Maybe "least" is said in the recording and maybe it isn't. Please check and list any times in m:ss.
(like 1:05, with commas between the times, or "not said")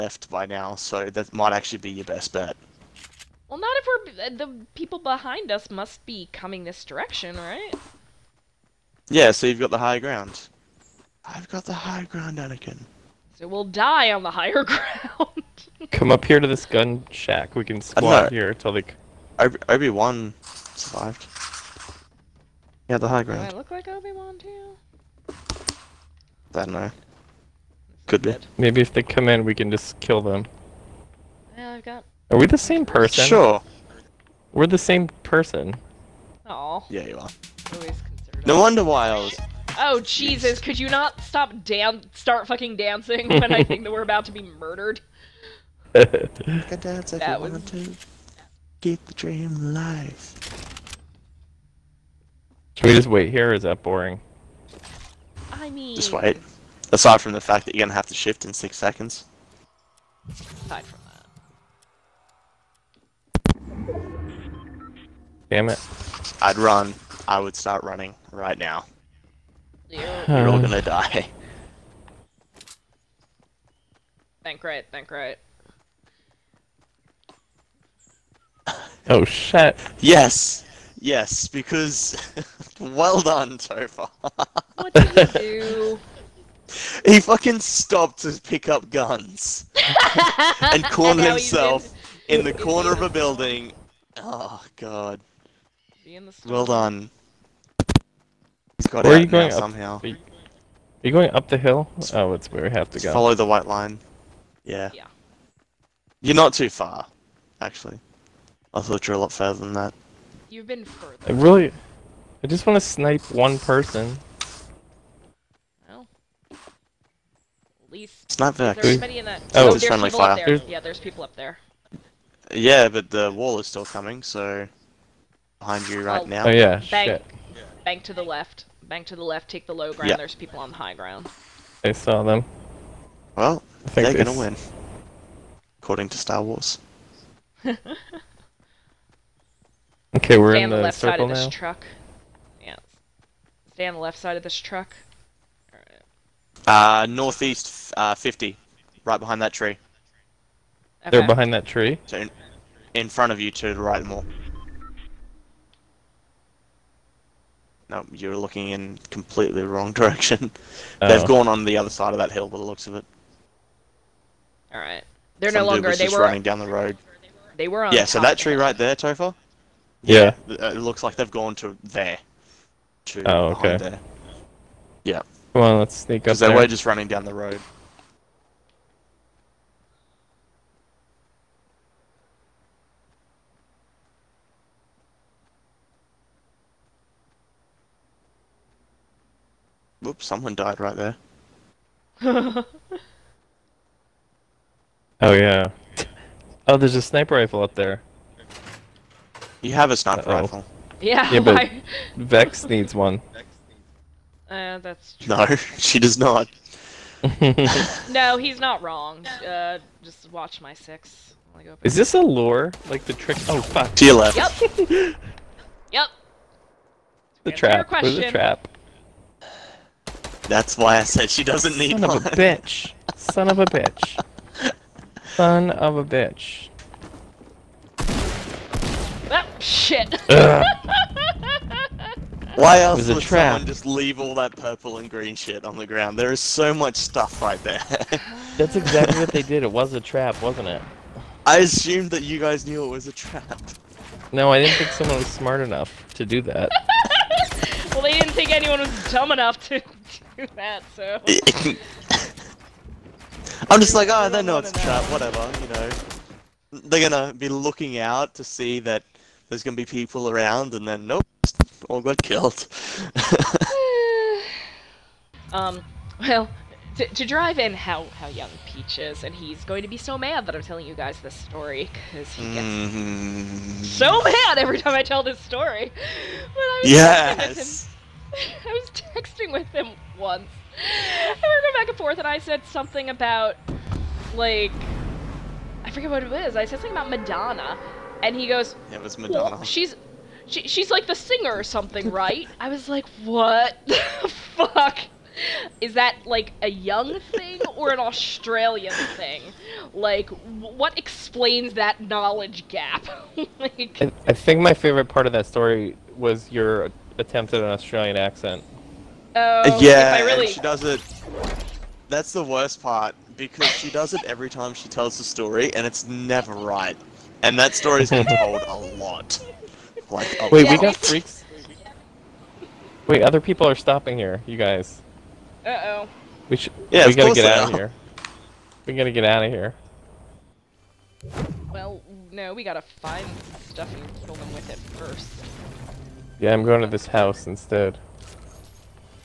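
1:57.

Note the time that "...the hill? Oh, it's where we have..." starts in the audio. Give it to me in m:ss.
1:41.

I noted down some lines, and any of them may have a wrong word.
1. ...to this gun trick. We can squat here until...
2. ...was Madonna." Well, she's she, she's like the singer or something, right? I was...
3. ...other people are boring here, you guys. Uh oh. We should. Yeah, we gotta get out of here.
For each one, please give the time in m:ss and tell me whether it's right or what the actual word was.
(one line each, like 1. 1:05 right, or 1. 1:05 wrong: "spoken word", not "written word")
1. 0:16 wrong: "shack", not "trick"
2. 4:49 right
3. 5:23 wrong: "stopping", not "boring".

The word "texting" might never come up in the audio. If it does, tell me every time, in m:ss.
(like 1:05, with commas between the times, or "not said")
4:38.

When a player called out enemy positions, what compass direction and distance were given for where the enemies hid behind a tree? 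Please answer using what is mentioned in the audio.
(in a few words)
northeast 50.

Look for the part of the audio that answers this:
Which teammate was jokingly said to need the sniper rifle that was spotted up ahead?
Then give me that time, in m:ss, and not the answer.
3:22.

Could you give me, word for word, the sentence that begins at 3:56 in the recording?
There is so much stuff right there.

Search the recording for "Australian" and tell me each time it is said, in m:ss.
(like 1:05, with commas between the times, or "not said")
4:57, 5:07.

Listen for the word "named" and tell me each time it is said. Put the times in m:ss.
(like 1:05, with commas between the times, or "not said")
not said.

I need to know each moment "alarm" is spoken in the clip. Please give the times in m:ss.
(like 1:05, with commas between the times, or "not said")
not said.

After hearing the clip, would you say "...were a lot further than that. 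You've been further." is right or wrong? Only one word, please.
right.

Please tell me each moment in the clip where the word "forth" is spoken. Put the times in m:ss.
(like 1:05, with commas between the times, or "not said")
4:41.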